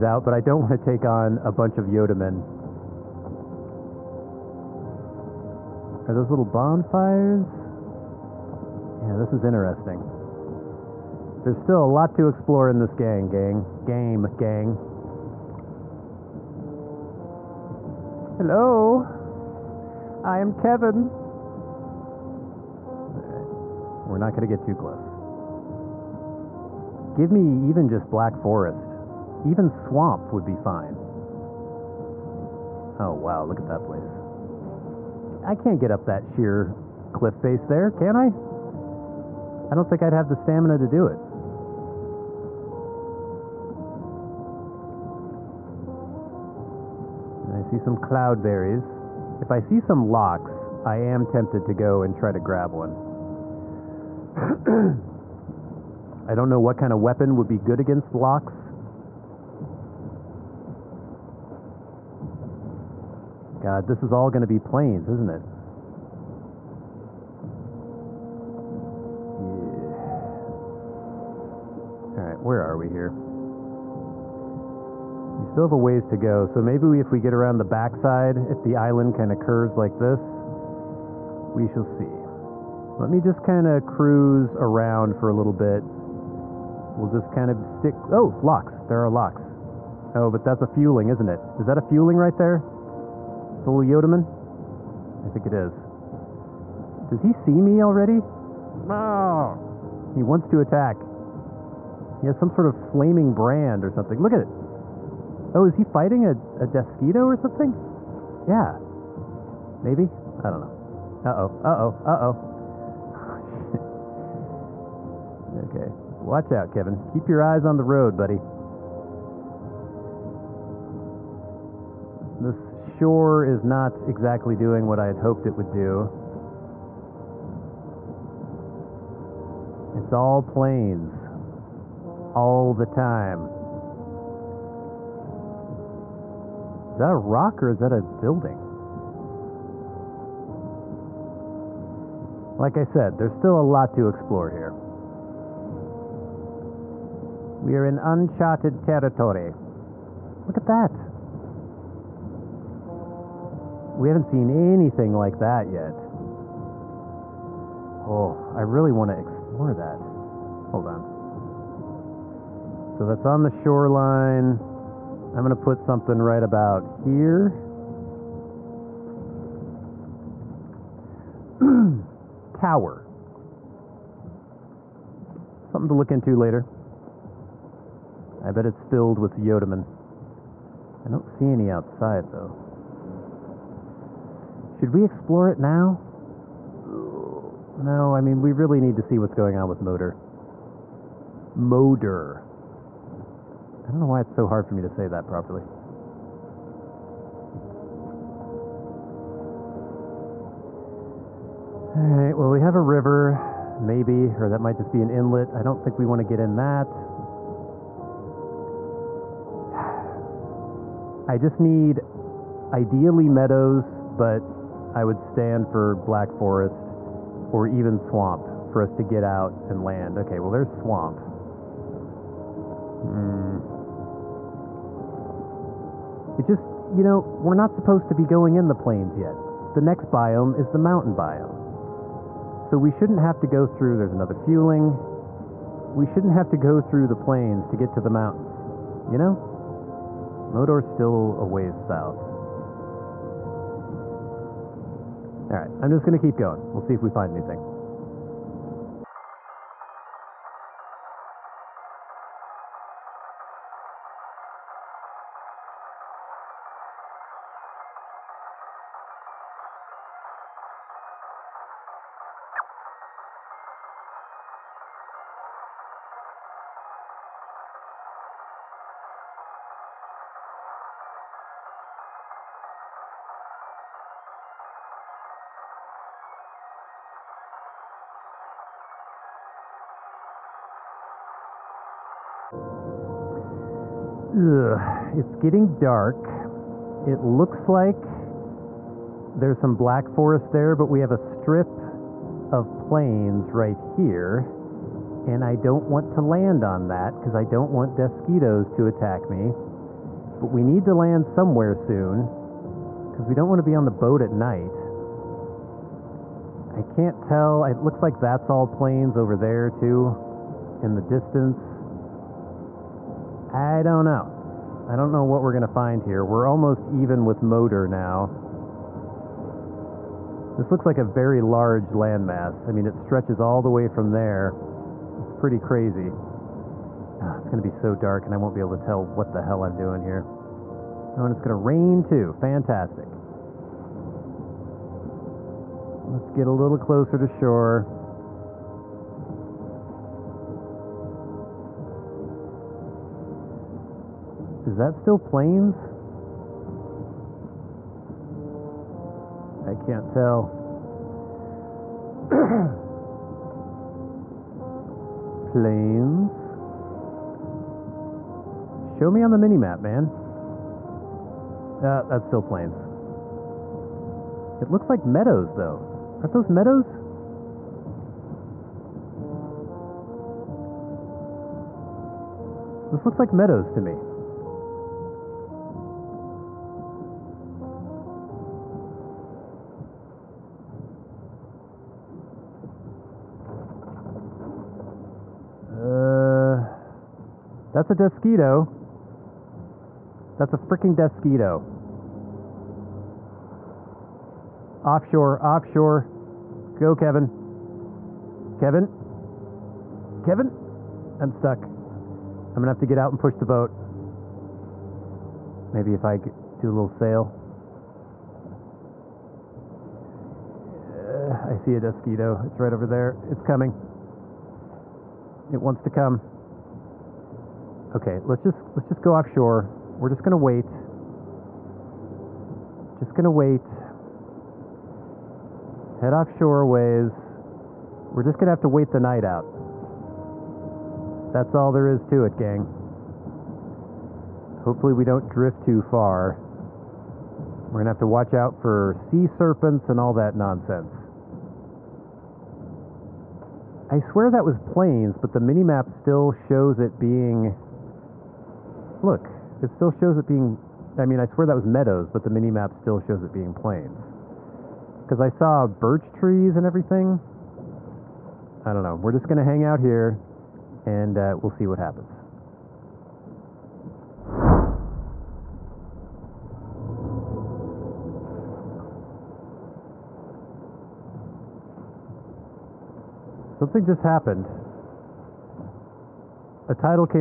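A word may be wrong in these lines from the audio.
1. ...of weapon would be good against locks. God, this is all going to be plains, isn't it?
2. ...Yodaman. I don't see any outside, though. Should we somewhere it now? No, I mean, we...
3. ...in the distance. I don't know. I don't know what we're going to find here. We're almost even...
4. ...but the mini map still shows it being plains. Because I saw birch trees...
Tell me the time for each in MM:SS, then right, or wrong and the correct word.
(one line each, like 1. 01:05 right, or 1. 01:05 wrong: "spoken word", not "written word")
1. 00:56 right
2. 02:59 wrong: "explore", not "somewhere"
3. 05:10 right
4. 07:32 right.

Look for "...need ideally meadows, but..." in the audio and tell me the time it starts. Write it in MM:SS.
03:31.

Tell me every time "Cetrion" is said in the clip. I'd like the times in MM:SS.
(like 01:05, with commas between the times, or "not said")
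not said.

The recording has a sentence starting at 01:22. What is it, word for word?
Let me just kind of cruise around for a little bit.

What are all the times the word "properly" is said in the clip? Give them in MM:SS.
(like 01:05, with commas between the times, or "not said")
03:15.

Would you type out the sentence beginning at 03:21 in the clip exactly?
All right, well, we have a river, maybe, or that might just be an inlet.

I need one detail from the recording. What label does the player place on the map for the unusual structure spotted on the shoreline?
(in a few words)
Tower.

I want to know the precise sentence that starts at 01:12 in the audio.
All right, where are we here?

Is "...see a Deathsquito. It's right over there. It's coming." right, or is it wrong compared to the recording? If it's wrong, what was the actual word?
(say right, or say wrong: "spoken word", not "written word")
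right.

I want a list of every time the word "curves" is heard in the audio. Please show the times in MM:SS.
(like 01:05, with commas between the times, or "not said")
01:19.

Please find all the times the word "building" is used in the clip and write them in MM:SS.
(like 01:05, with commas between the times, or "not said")
02:18.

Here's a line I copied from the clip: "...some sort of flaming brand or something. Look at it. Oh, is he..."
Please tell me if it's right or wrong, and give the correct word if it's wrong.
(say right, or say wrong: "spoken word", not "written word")
right.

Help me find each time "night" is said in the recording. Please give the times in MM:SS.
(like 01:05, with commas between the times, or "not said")
05:04, 07:08.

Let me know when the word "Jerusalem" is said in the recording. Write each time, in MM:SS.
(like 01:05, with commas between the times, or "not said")
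not said.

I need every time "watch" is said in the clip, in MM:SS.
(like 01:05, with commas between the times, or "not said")
01:56, 07:18.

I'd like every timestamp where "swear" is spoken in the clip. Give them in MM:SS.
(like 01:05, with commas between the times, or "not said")
07:23, 07:31.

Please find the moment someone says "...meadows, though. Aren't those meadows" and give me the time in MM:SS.
06:05.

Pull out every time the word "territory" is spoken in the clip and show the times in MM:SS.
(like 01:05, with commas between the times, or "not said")
02:28.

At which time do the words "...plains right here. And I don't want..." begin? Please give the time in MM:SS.
04:52.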